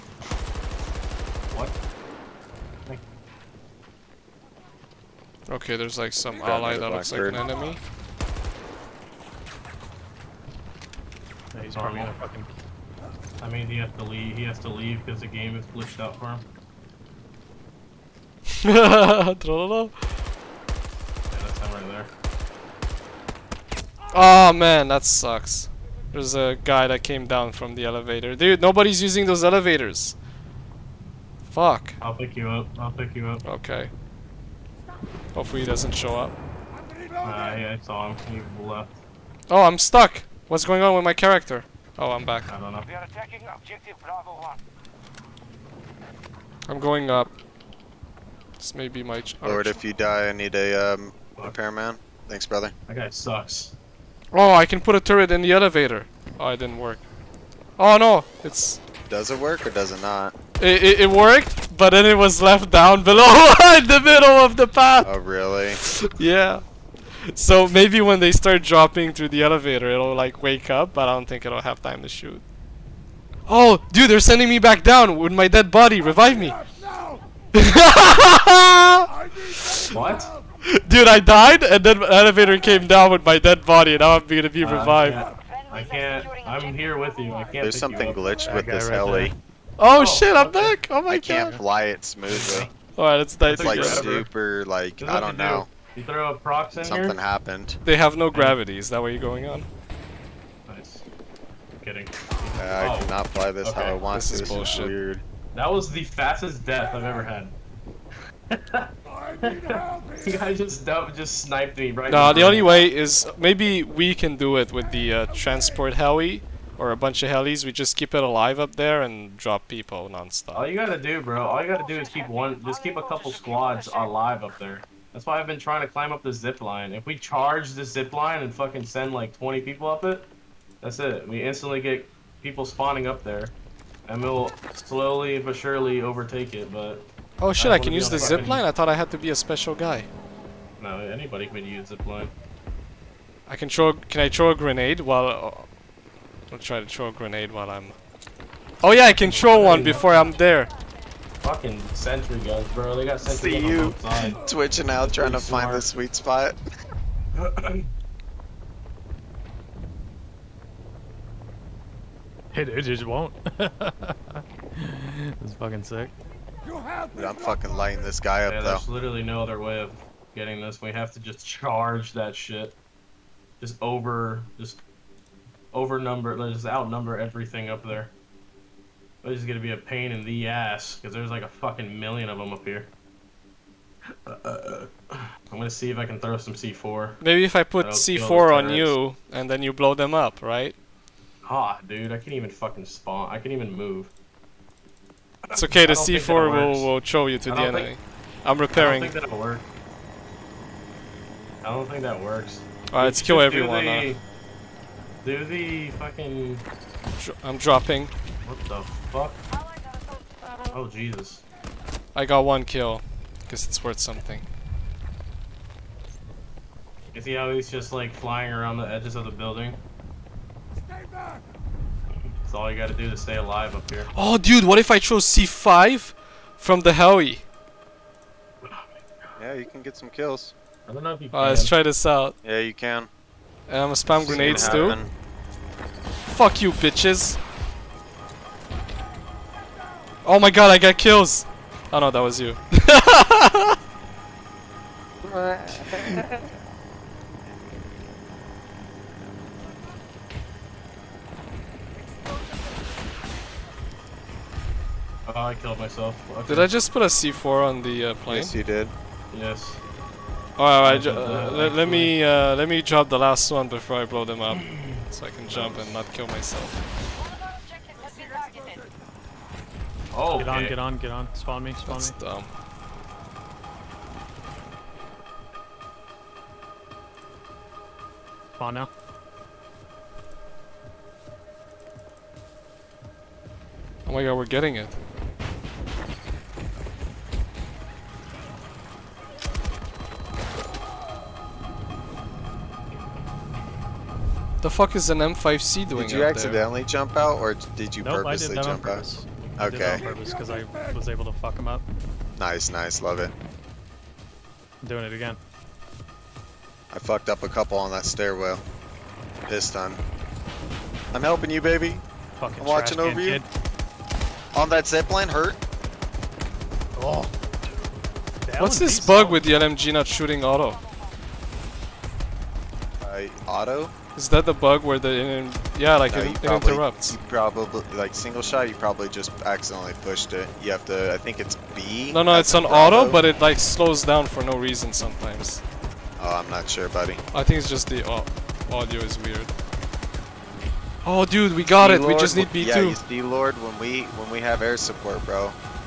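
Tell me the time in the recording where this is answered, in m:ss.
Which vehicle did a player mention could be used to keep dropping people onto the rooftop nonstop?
1:55.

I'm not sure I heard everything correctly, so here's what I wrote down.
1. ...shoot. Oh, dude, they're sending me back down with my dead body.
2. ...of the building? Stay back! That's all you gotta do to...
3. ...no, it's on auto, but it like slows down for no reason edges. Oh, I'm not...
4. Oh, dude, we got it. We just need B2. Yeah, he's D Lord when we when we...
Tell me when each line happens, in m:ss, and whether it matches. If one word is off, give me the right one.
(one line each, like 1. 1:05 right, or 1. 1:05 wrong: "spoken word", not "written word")
1. 1:12 right
2. 3:39 right
3. 5:32 wrong: "sometimes", not "edges"
4. 5:41 right.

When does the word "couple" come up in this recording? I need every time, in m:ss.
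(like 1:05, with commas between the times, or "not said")
2:03, 5:07.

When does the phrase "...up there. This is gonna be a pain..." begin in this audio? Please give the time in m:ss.
2:57.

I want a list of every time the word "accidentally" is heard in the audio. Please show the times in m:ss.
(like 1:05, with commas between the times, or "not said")
4:56, 5:29.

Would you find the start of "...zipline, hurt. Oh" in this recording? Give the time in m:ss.
5:14.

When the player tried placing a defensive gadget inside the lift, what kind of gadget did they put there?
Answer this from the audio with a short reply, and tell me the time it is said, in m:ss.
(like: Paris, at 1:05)
turret, at 0:55.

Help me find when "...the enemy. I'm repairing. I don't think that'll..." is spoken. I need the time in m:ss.
3:17.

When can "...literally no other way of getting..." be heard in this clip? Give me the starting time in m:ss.
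2:48.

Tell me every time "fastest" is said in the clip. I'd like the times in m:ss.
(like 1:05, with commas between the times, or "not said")
1:46.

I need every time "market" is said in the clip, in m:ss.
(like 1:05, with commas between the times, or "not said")
not said.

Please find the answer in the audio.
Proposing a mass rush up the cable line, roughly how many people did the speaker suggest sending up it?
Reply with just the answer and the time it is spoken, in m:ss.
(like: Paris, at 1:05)
20, at 2:09.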